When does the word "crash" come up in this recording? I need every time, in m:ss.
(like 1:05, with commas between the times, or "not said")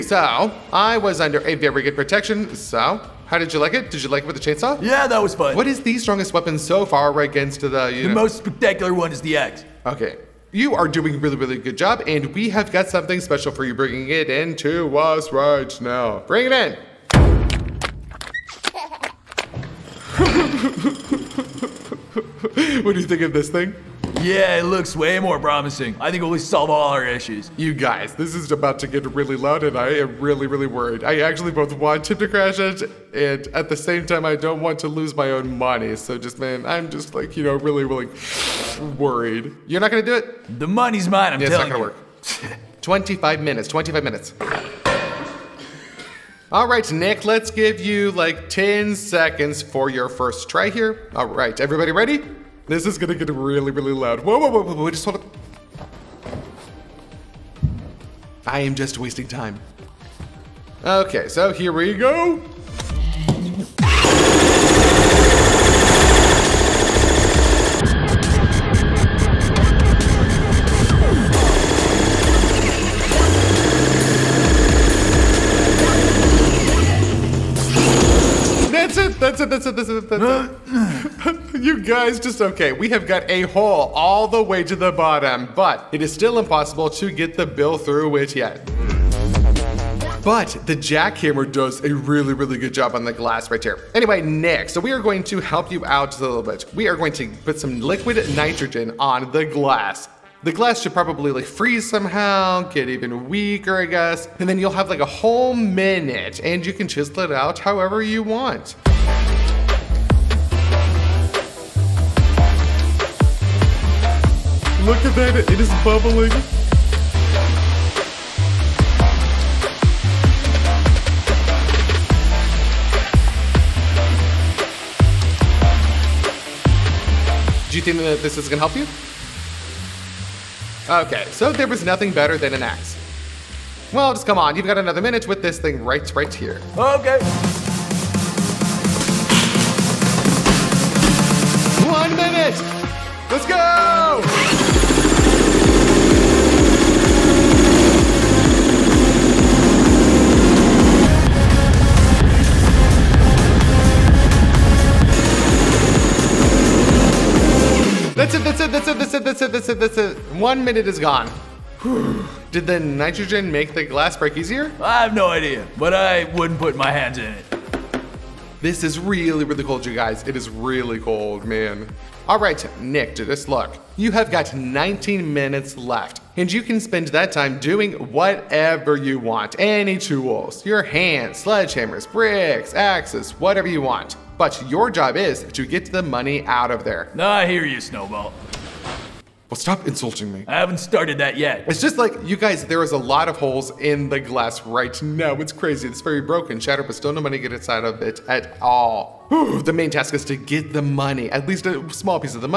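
0:32.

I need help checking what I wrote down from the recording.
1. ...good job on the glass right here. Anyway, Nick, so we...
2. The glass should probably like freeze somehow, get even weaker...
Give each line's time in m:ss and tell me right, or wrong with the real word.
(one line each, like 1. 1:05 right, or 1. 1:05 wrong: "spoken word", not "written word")
1. 1:32 right
2. 1:40 right.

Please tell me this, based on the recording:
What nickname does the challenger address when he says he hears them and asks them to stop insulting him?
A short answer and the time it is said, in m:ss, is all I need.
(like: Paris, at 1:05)
Snowball, at 3:07.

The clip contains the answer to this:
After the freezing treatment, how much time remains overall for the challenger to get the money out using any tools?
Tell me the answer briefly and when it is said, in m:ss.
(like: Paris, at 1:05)
19 minutes, at 2:54.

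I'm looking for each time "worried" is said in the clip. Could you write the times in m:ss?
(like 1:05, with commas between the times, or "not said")
0:30, 0:38.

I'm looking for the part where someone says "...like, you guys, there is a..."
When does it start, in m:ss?
3:11.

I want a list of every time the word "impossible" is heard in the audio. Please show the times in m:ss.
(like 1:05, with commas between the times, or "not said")
1:26.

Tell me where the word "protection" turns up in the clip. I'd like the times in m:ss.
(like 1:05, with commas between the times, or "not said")
0:01.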